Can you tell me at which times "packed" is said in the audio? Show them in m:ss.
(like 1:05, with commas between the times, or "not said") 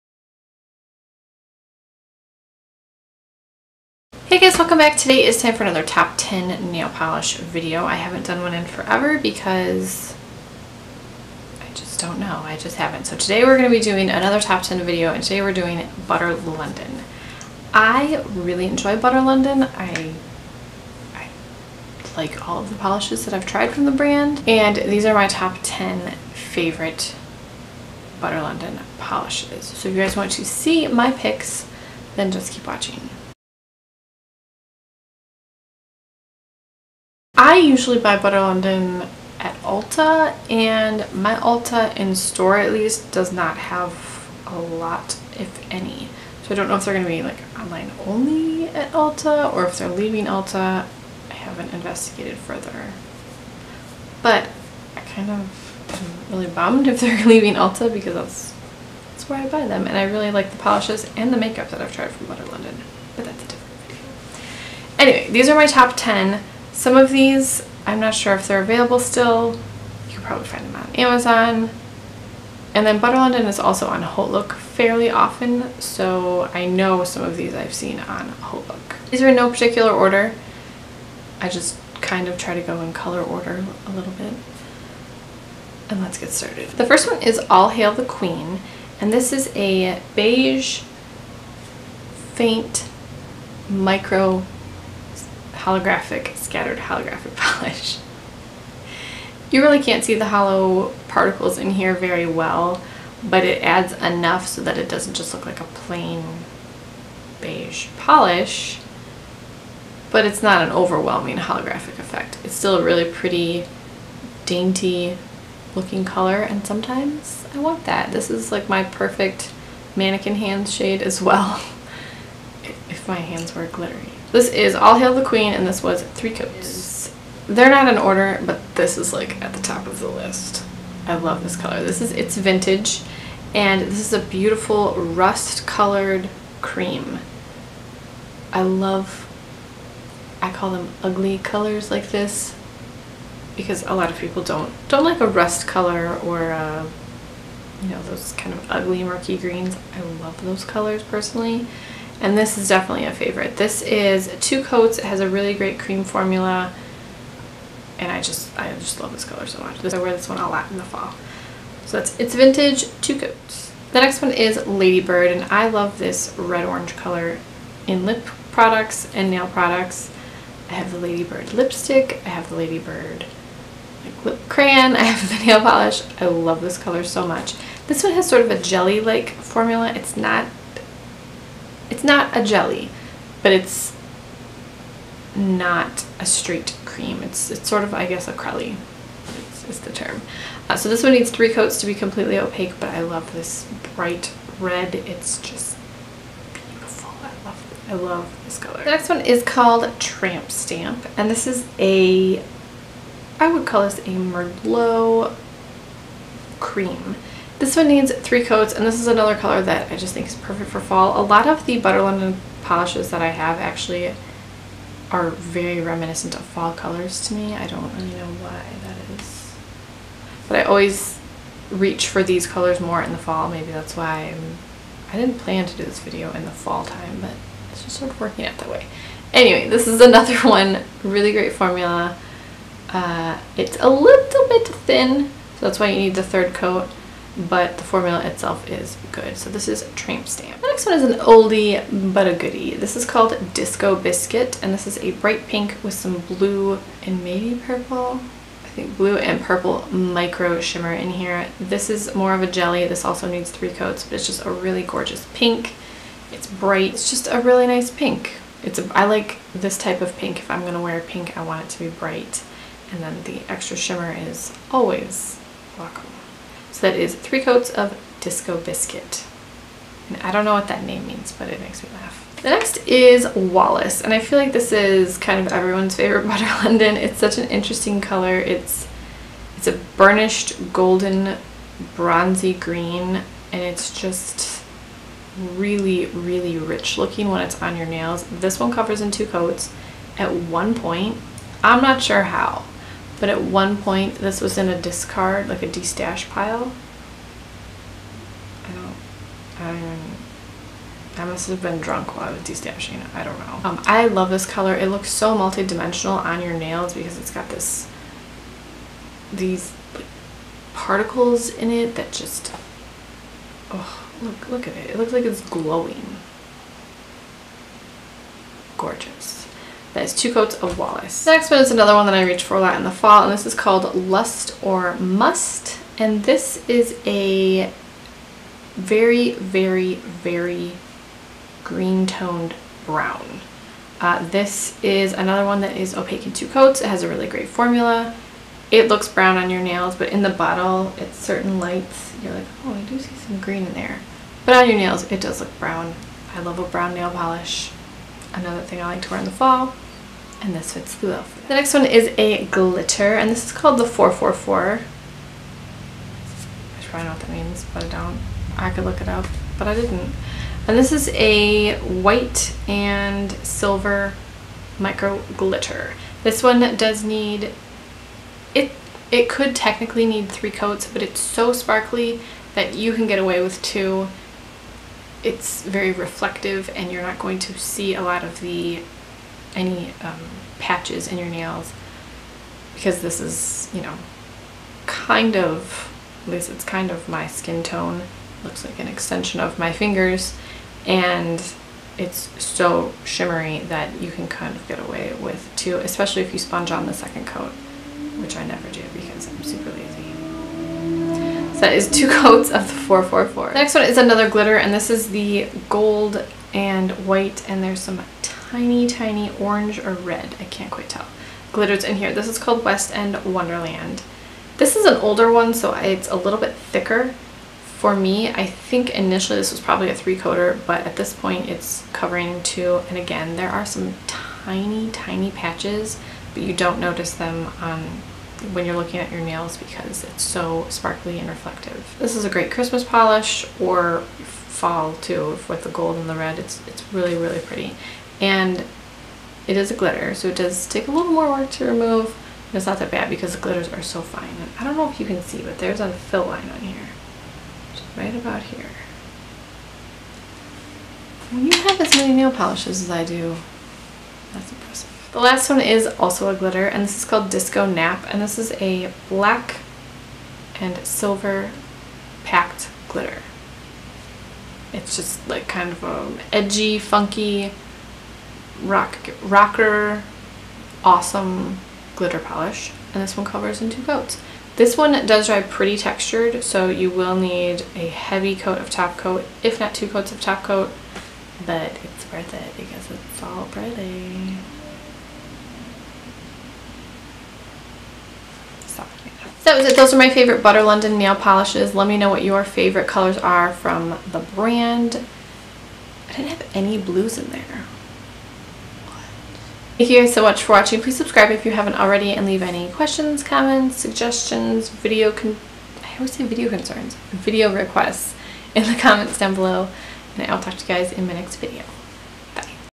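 7:42.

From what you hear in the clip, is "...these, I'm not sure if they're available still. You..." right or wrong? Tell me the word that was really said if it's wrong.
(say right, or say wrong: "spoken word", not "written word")
right.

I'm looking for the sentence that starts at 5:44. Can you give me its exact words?
But on your nails, it does look brown.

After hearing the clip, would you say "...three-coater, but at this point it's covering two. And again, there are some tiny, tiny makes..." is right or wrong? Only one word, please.
wrong.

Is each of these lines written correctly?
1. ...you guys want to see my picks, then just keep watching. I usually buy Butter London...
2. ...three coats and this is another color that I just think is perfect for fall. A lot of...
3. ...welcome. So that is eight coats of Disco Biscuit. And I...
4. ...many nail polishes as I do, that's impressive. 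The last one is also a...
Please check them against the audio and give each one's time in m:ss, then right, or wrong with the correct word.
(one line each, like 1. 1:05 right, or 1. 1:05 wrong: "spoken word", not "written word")
1. 0:29 right
2. 3:28 right
3. 4:25 wrong: "three", not "eight"
4. 7:31 right.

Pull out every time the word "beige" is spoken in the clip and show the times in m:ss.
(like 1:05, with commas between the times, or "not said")
1:30, 1:47.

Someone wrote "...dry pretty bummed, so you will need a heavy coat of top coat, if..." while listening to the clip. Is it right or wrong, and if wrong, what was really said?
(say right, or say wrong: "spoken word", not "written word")
wrong: "textured", not "bummed".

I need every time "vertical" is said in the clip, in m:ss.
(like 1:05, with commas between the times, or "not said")
not said.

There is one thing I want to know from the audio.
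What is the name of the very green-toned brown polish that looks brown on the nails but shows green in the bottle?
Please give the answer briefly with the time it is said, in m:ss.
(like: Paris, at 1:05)
Lust or Must, at 5:23.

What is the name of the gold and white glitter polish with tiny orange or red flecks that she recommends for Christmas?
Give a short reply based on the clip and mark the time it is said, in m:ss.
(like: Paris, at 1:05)
West End Wonderland, at 6:52.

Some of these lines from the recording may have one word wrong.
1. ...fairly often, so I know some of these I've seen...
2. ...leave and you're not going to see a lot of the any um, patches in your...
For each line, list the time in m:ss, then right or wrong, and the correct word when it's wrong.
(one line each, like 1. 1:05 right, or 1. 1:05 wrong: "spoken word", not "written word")
1. 1:14 right
2. 6:15 wrong: "reflective", not "leave".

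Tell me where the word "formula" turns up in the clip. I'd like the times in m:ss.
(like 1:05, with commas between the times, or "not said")
2:36, 2:59, 3:51, 3:57, 5:37.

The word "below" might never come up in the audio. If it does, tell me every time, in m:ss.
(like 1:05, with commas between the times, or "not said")
8:29.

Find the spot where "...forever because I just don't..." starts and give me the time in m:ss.
0:08.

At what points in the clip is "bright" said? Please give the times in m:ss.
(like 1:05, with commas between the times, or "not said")
3:13, 4:05, 4:16, 4:21.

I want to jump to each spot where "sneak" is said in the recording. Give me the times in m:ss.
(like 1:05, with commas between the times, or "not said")
not said.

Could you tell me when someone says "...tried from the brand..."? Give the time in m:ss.
0:23.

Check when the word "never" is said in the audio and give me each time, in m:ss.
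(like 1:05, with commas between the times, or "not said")
6:38.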